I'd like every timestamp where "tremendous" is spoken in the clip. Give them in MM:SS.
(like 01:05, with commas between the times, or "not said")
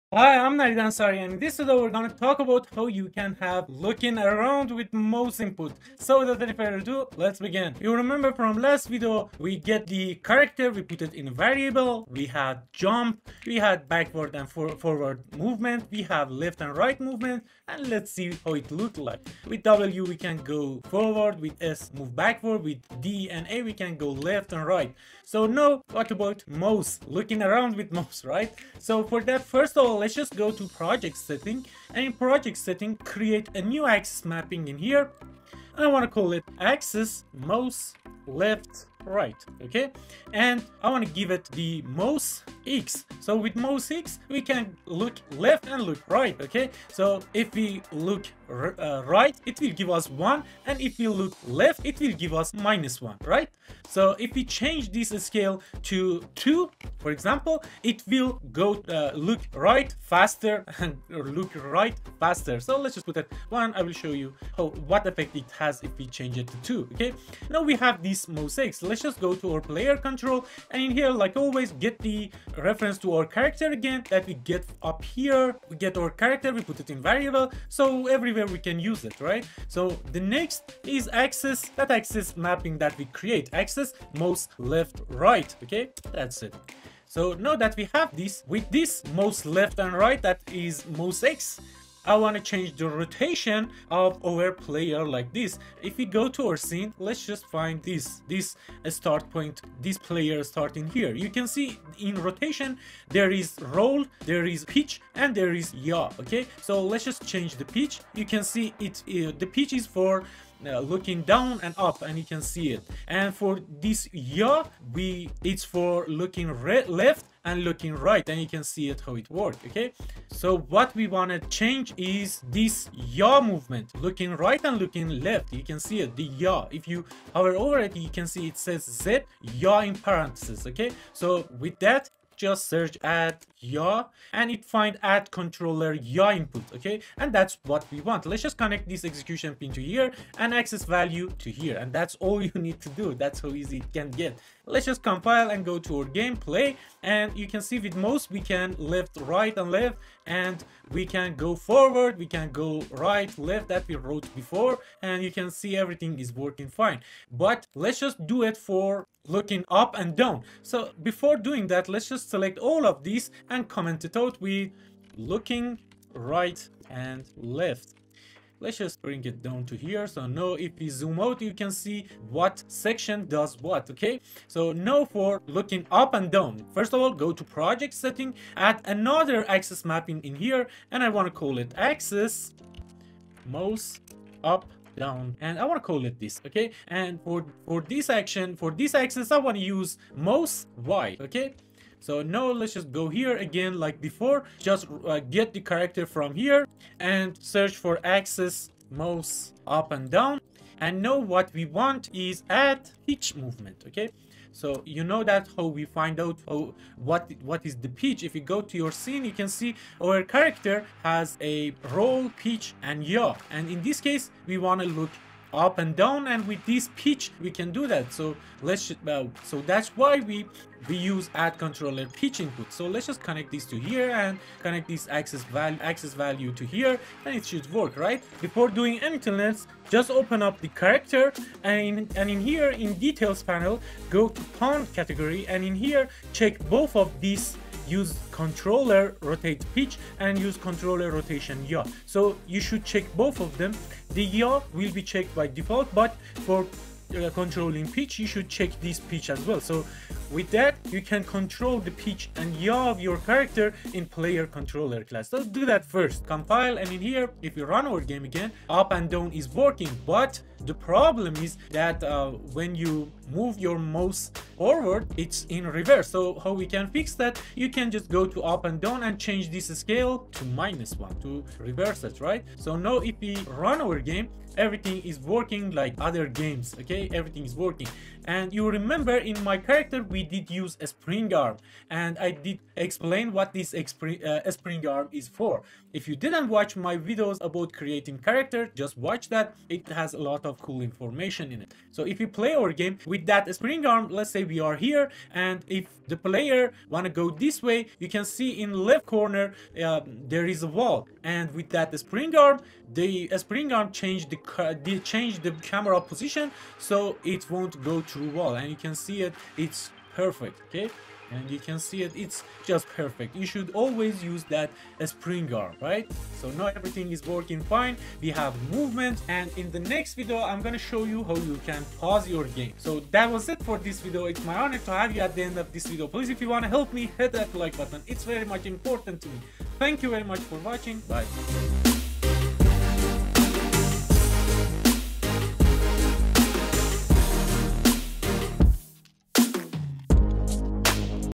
not said.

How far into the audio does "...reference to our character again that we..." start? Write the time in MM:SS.
01:12.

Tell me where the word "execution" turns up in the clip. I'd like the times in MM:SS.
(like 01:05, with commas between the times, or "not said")
02:19.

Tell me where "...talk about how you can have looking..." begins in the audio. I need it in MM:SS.
00:02.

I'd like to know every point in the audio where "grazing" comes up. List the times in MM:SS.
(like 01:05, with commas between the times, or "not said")
not said.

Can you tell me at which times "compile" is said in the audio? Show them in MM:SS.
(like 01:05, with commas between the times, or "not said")
02:25, 04:16.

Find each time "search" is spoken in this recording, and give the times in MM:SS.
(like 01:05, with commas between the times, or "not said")
02:12, 03:17.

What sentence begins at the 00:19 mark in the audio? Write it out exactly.
With W we can go forward, with S move backward, with D and A we can go left and right.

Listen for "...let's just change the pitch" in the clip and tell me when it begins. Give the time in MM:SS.
01:46.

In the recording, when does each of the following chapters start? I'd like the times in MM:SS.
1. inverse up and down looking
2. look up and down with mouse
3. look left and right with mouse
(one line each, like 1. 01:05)
1. 04:18
2. 02:54
3. 00:28.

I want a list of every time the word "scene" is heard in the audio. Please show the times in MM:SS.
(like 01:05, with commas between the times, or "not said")
01:36, 03:28.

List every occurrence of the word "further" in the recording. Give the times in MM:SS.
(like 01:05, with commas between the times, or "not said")
00:06.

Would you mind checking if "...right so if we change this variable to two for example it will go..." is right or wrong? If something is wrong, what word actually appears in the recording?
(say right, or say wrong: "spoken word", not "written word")
wrong: "scale", not "variable".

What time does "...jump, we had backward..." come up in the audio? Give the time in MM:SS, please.
00:12.